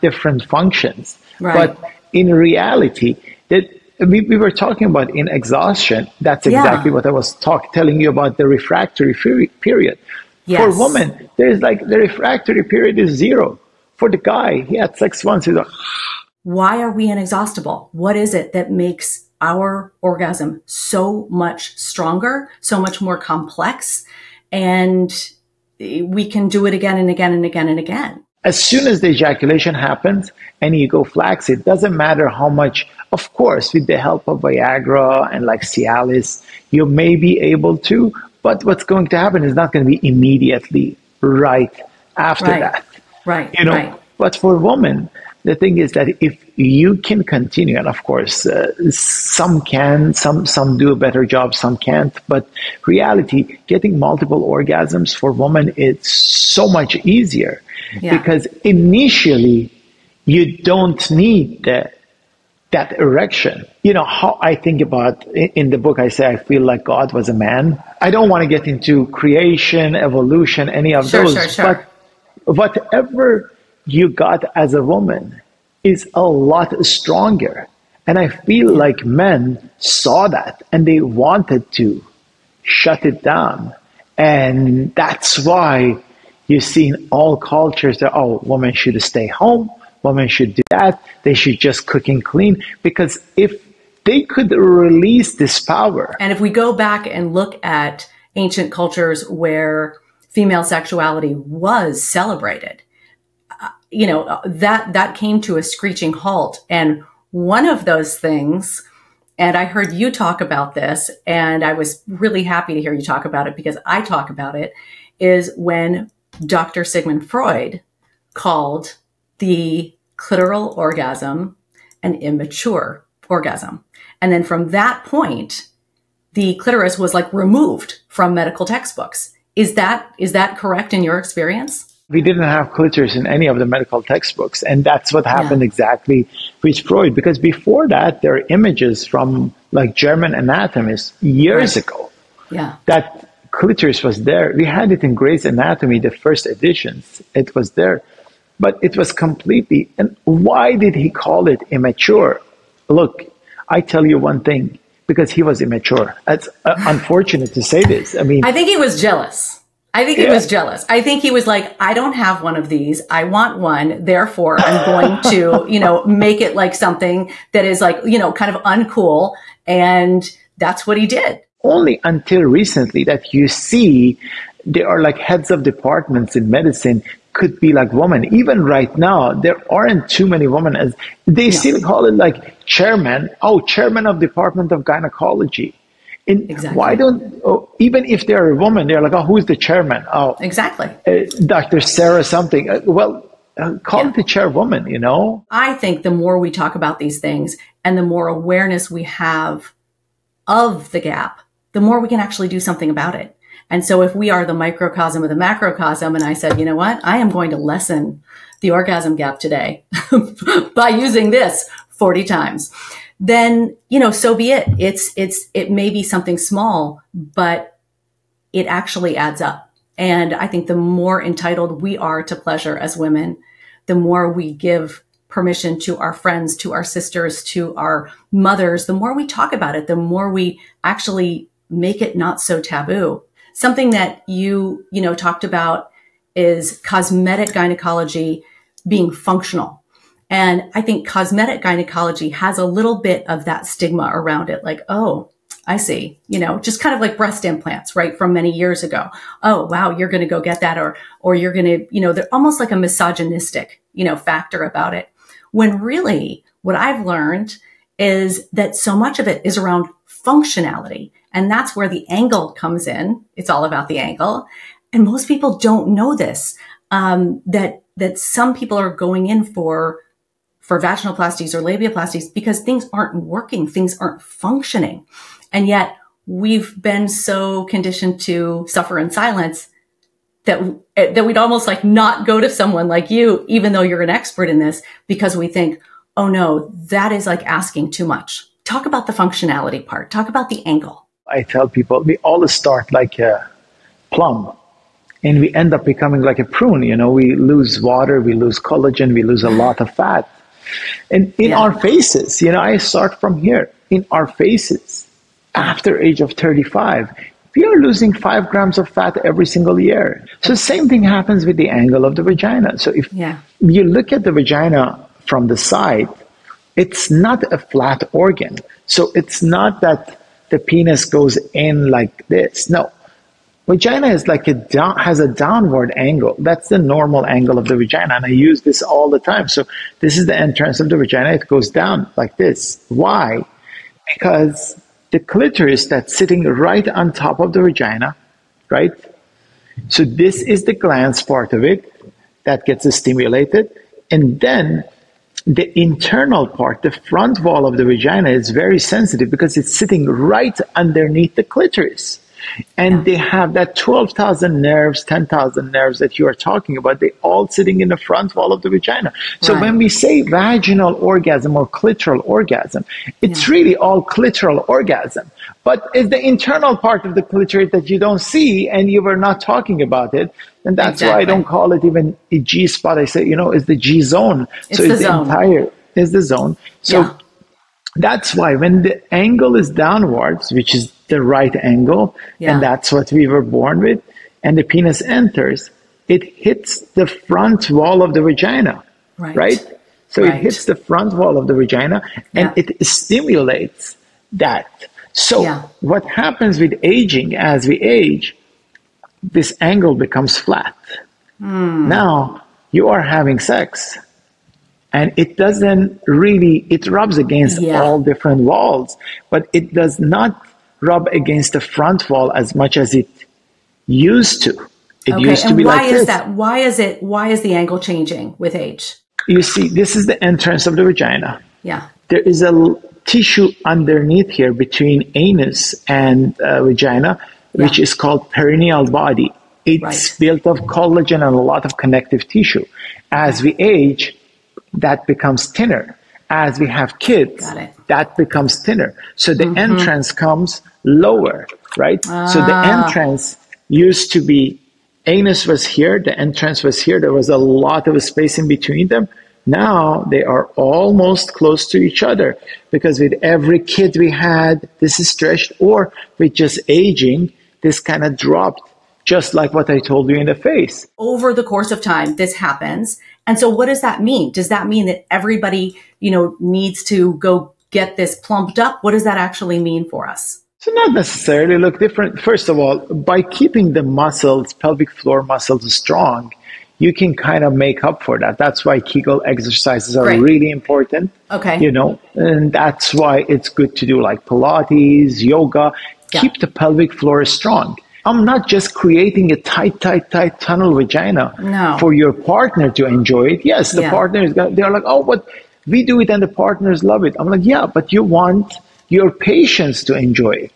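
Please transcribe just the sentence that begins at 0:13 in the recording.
For the guy, he had sex once, he's like, why are we inexhaustible?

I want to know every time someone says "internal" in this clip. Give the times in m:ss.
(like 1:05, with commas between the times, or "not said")
5:45, 6:06.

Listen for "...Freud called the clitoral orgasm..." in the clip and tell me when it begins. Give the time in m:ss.
1:57.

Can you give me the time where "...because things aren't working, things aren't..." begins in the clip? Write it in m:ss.
4:32.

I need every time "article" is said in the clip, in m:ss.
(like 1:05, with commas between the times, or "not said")
not said.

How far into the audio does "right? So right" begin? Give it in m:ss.
6:29.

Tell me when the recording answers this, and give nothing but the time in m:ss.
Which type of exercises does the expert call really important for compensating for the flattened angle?
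7:58.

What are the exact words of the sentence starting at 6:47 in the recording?
all different walls but it does not rub against the front wall as much as it used to.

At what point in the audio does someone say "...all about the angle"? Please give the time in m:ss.
4:23.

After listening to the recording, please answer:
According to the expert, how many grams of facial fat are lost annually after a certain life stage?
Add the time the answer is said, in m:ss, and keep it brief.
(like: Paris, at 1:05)
5 grams, at 5:08.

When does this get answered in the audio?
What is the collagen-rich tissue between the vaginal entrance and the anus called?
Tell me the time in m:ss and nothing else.
7:08.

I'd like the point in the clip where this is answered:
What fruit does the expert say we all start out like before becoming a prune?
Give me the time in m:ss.
4:54.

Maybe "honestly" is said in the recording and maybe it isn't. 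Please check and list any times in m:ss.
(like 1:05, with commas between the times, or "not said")
not said.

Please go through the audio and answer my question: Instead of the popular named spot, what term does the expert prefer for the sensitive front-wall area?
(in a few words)
G zone.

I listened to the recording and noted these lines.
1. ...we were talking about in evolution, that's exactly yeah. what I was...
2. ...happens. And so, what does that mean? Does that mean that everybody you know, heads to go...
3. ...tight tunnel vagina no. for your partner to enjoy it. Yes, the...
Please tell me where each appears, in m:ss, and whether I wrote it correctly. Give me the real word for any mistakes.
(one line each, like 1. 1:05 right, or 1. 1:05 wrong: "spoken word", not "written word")
1. 0:04 wrong: "exhaustion", not "evolution"
2. 7:42 wrong: "needs", not "heads"
3. 8:10 right.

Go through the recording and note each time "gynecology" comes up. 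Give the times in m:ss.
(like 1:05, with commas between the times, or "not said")
3:04, 3:57, 4:01.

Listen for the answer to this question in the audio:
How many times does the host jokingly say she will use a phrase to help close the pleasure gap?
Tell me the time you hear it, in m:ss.
3:31.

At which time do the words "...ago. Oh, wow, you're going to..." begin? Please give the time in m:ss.
4:08.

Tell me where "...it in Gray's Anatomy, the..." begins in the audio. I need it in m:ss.
2:24.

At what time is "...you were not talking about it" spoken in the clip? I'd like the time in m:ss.
6:08.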